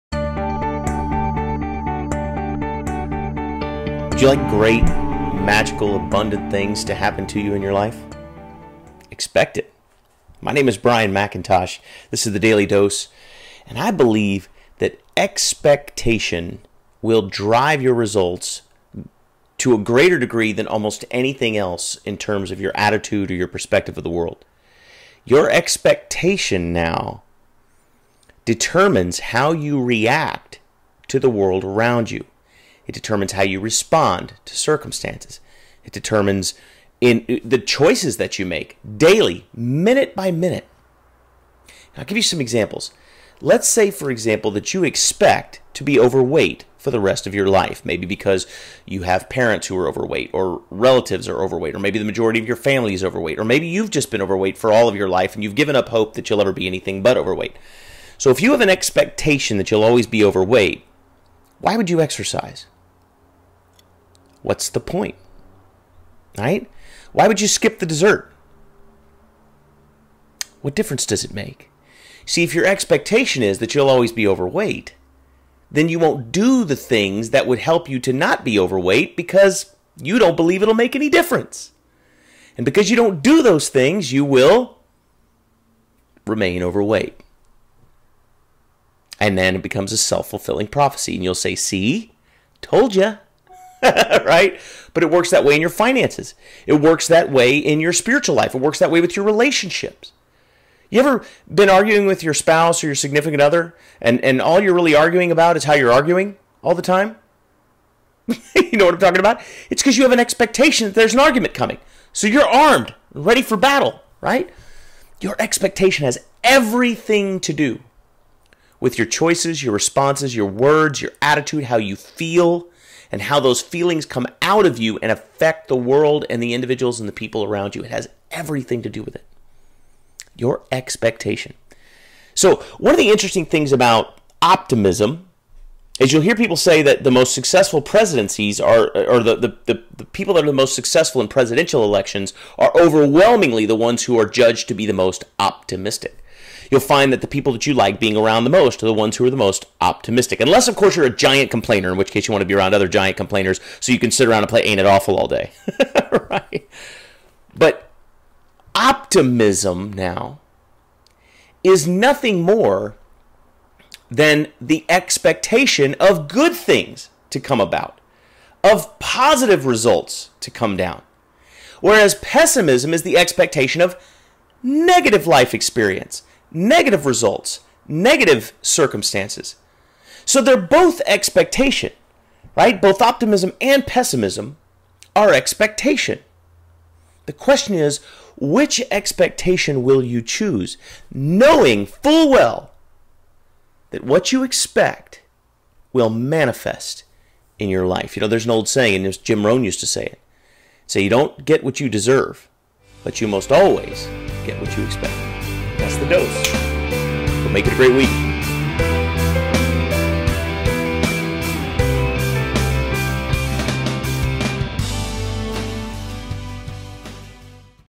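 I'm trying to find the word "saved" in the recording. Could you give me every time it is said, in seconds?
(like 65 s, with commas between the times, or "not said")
not said.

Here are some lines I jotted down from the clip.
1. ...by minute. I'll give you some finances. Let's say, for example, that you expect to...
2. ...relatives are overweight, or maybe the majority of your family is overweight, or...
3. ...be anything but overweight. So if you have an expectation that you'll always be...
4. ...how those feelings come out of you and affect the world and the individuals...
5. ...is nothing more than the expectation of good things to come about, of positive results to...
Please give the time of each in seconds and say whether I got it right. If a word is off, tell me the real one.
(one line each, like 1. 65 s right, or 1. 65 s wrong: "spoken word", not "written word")
1. 40 s wrong: "examples", not "finances"
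2. 50 s right
3. 56 s right
4. 123 s right
5. 161 s right.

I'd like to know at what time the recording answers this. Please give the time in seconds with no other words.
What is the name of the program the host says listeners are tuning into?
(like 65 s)
12 s.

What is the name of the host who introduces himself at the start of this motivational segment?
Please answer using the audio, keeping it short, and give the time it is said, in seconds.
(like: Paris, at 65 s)
Brian McIntosh, at 10 s.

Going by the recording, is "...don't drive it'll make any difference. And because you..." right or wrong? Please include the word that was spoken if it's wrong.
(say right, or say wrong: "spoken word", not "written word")
wrong: "believe", not "drive".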